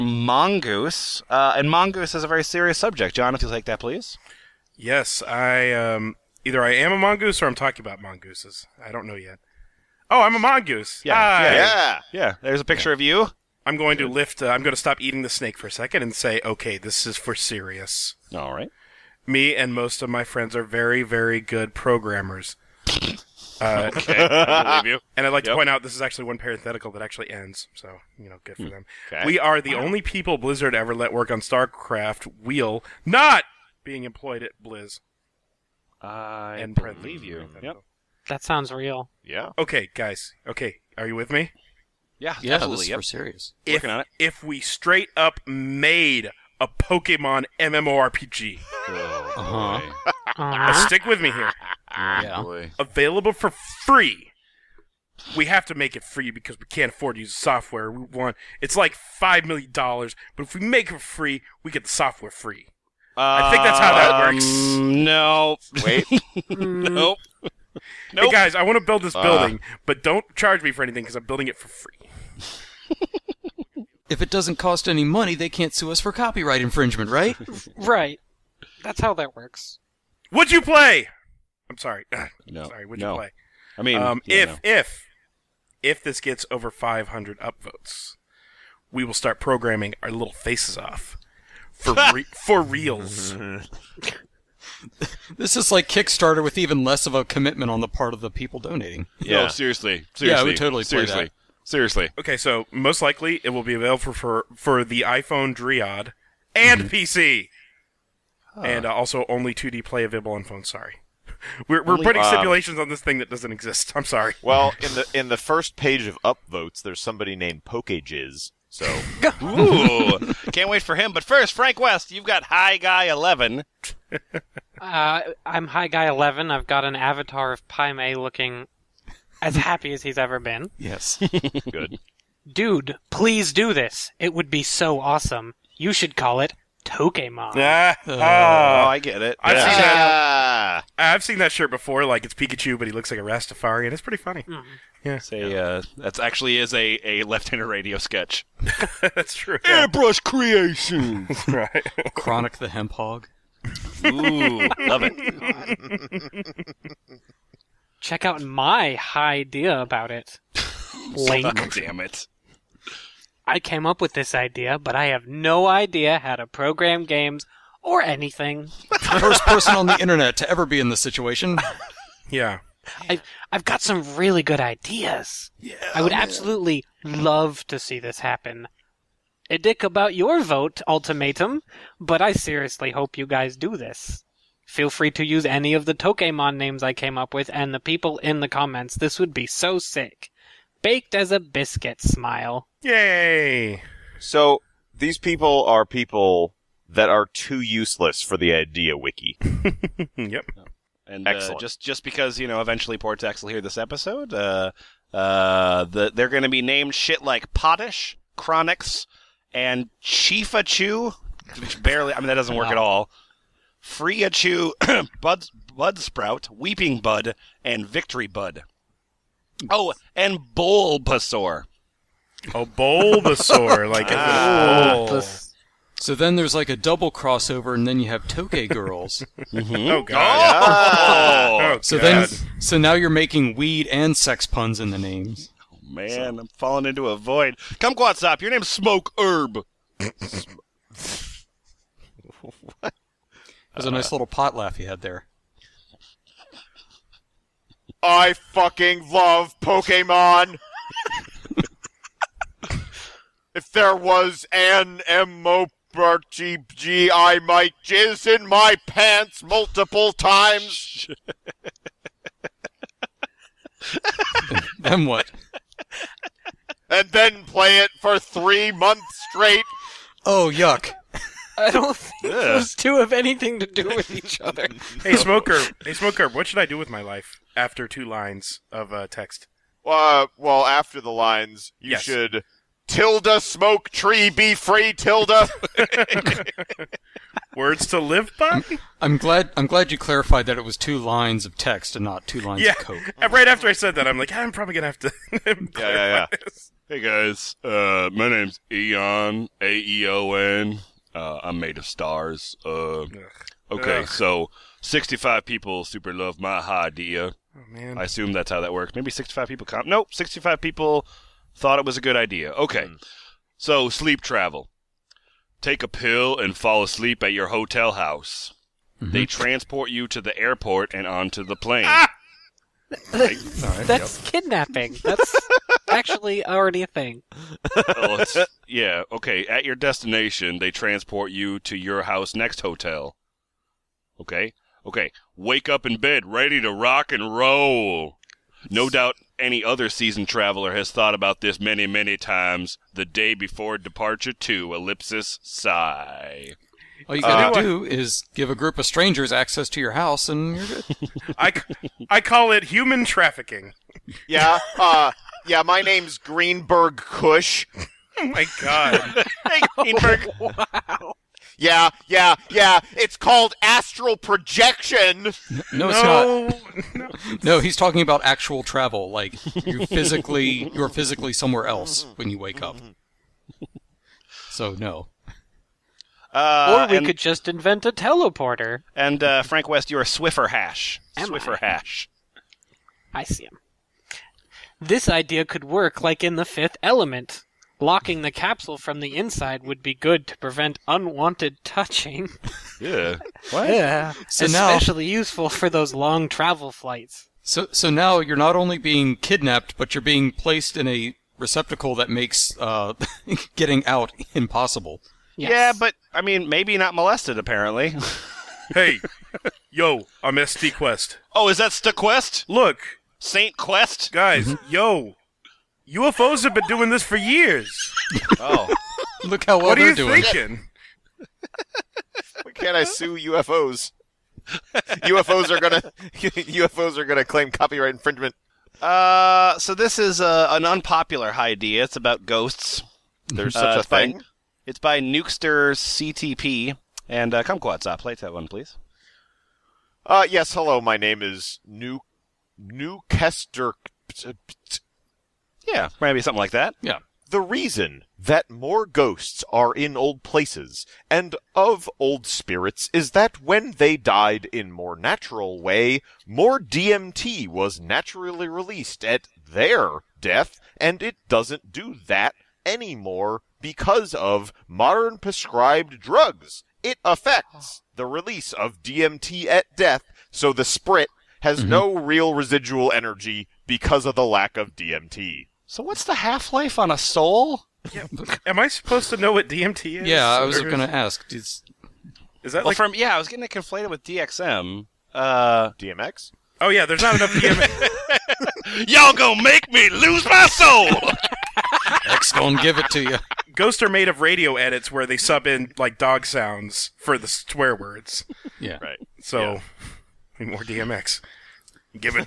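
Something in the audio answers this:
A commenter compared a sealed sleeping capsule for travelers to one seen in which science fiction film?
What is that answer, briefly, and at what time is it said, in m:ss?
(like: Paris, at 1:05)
The Fifth Element, at 6:26.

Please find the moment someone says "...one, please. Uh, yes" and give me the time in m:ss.
7:18.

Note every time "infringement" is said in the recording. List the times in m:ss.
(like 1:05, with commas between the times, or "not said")
1:16, 7:07.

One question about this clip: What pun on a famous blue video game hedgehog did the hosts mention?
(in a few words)
Chronic the Hemp Hog.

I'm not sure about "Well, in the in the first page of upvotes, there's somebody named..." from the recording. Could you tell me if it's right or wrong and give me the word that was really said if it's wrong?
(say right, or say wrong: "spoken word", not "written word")
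right.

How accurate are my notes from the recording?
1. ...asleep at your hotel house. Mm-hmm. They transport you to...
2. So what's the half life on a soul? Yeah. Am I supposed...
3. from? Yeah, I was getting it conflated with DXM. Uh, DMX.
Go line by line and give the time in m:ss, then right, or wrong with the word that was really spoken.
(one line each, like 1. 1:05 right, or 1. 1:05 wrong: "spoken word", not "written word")
1. 5:16 right
2. 7:55 right
3. 8:02 right.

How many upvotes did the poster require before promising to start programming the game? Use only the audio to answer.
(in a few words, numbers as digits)
500.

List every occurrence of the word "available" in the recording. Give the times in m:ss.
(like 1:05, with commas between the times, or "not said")
0:52, 1:43, 1:50.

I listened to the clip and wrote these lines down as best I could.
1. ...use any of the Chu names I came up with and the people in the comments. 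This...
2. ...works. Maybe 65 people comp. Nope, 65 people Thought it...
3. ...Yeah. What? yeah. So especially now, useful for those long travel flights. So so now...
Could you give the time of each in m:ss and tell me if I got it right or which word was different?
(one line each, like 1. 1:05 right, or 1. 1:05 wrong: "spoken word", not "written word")
1. 3:05 wrong: "Tokemon", not "Chu"
2. 5:08 right
3. 6:32 right.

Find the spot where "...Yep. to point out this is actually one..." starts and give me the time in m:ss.
0:25.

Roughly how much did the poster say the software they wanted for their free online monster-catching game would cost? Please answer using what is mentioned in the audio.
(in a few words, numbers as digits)
5 million dollars.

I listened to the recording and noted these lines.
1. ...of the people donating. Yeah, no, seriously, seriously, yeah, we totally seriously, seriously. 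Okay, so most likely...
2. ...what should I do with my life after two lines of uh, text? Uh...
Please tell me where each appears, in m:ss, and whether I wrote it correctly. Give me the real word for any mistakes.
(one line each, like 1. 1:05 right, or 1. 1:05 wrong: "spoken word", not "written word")
1. 1:38 right
2. 4:36 right.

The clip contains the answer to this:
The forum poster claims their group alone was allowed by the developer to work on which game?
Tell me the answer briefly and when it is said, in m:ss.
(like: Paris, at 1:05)
StarCraft, at 0:31.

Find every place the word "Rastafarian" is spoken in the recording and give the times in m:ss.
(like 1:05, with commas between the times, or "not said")
2:23.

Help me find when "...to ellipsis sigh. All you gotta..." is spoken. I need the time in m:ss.
5:44.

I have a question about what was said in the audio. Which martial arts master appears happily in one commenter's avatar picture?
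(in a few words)
Pai Mei.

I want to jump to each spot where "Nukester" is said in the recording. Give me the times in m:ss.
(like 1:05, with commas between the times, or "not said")
7:14, 7:22.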